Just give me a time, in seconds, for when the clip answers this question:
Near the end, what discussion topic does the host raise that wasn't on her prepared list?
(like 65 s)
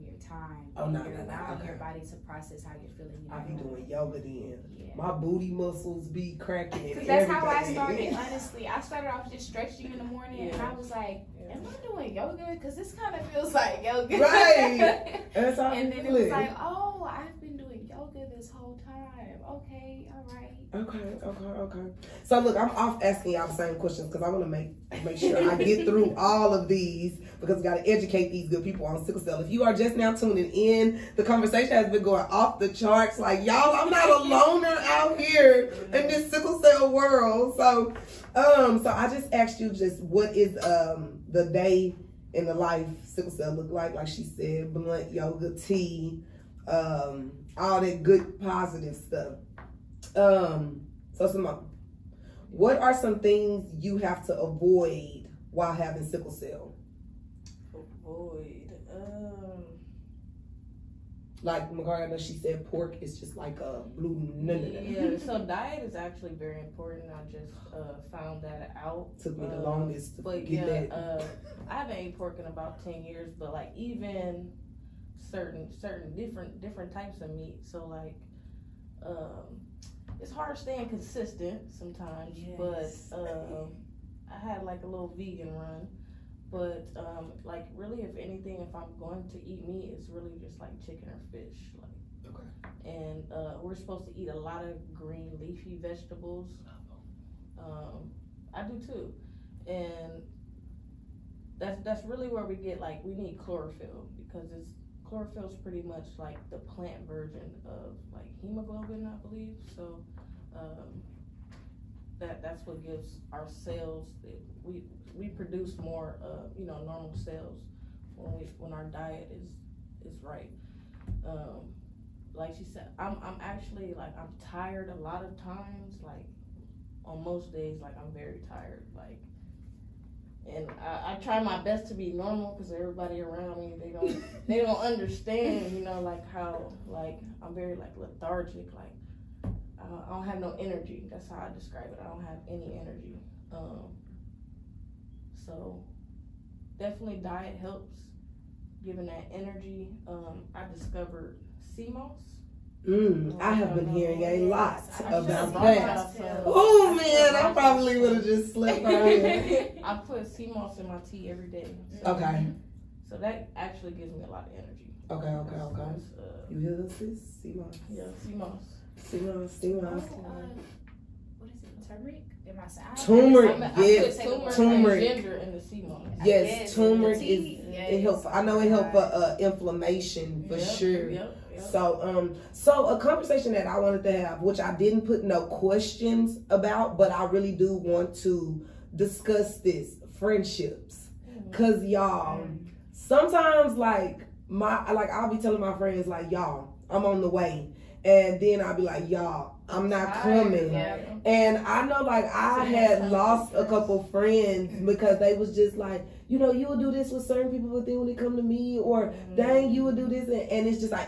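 190 s.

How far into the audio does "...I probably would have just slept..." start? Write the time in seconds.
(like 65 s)
157 s.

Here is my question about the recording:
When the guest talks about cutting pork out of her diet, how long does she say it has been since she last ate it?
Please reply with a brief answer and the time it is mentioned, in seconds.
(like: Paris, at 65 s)
10 years, at 72 s.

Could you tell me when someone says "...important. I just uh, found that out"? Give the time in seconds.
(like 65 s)
66 s.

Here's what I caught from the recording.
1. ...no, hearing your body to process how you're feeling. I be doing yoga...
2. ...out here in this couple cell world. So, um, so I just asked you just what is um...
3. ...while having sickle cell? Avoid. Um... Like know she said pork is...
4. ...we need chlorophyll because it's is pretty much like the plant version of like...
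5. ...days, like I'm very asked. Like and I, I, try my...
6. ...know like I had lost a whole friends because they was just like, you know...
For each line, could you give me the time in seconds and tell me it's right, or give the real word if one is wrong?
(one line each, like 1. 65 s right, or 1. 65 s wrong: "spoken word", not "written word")
1. 1 s wrong: "allowing", not "hearing"
2. 34 s wrong: "sickle", not "couple"
3. 55 s right
4. 103 s right
5. 127 s wrong: "tired", not "asked"
6. 201 s wrong: "couple", not "whole".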